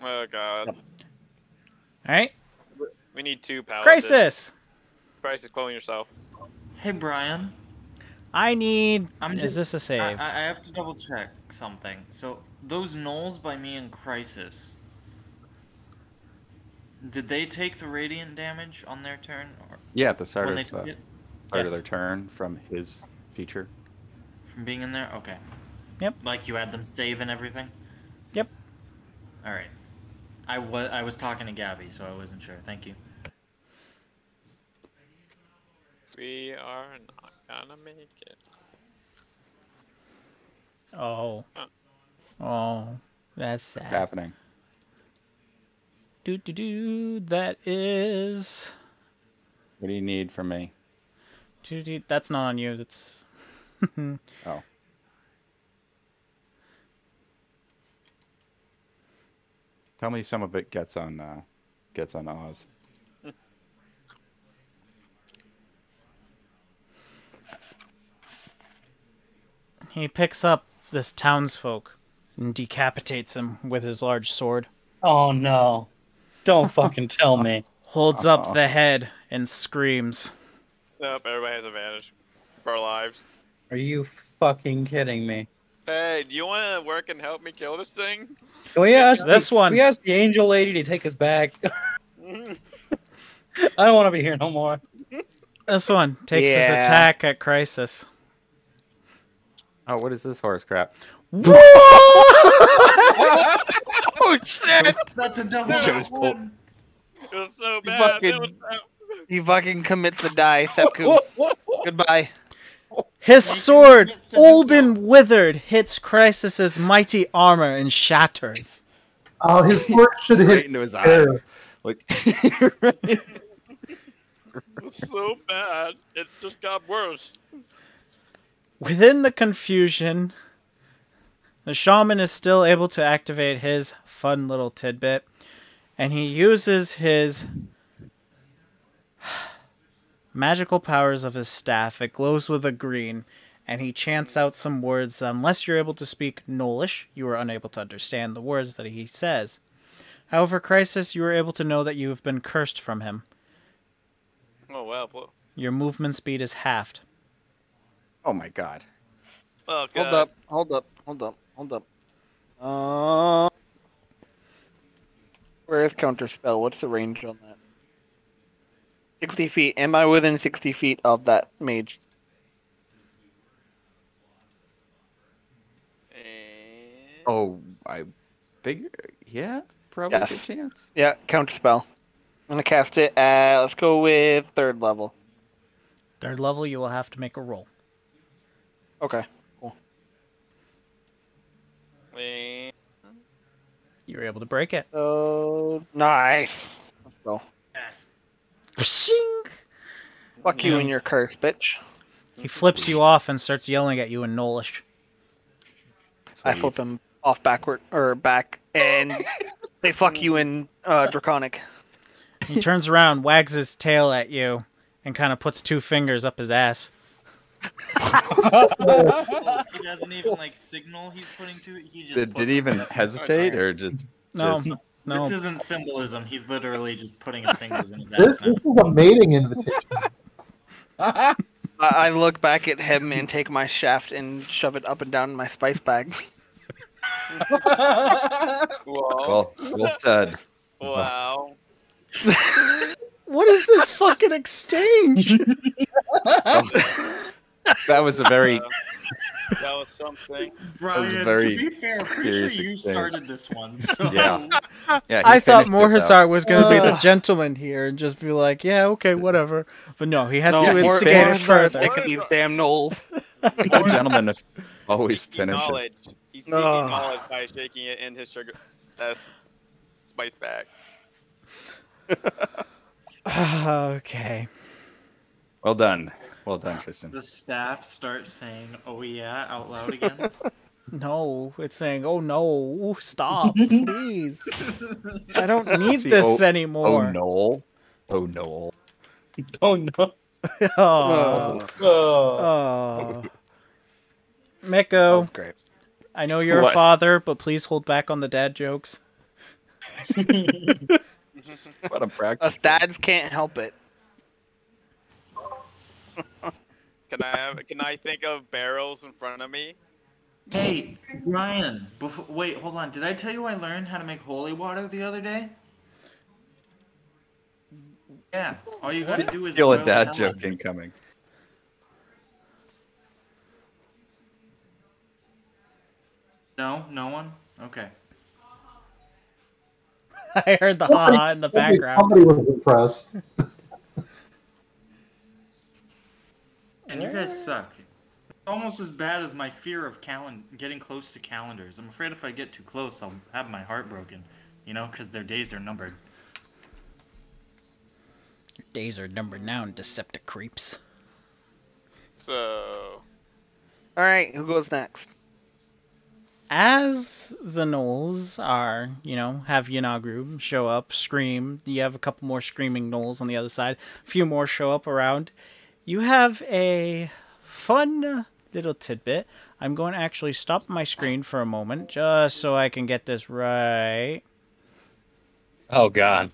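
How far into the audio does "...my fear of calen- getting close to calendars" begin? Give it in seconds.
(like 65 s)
339 s.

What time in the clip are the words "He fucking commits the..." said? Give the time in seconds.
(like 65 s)
109 s.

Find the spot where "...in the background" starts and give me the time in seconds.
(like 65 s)
331 s.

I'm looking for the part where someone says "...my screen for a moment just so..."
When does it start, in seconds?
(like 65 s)
370 s.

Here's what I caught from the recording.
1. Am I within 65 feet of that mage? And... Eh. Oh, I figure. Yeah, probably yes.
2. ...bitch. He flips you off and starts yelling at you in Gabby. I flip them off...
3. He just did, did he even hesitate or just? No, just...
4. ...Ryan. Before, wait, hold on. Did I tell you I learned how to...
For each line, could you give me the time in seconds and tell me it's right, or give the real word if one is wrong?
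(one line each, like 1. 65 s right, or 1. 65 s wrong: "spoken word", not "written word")
1. 169 s wrong: "60", not "65"
2. 201 s wrong: "Gnollish", not "Gabby"
3. 221 s right
4. 311 s right.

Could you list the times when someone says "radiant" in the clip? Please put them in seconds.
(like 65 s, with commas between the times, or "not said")
17 s.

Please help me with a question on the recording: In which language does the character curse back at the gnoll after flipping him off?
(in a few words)
Draconic.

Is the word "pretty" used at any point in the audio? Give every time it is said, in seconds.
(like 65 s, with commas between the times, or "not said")
252 s.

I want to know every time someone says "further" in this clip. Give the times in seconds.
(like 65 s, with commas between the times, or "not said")
261 s.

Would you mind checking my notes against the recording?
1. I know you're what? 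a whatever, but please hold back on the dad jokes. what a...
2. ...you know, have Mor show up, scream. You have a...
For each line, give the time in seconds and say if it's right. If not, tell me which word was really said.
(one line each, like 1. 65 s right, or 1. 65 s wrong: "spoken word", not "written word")
1. 296 s wrong: "father", not "whatever"
2. 359 s wrong: "Yeenoghu", not "Mor".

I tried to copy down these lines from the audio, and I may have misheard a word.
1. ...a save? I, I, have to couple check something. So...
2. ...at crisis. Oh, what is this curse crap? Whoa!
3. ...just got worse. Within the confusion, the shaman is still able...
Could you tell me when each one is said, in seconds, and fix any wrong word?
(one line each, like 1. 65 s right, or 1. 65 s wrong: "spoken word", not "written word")
1. 9 s wrong: "double", not "couple"
2. 97 s wrong: "horse", not "curse"
3. 126 s right.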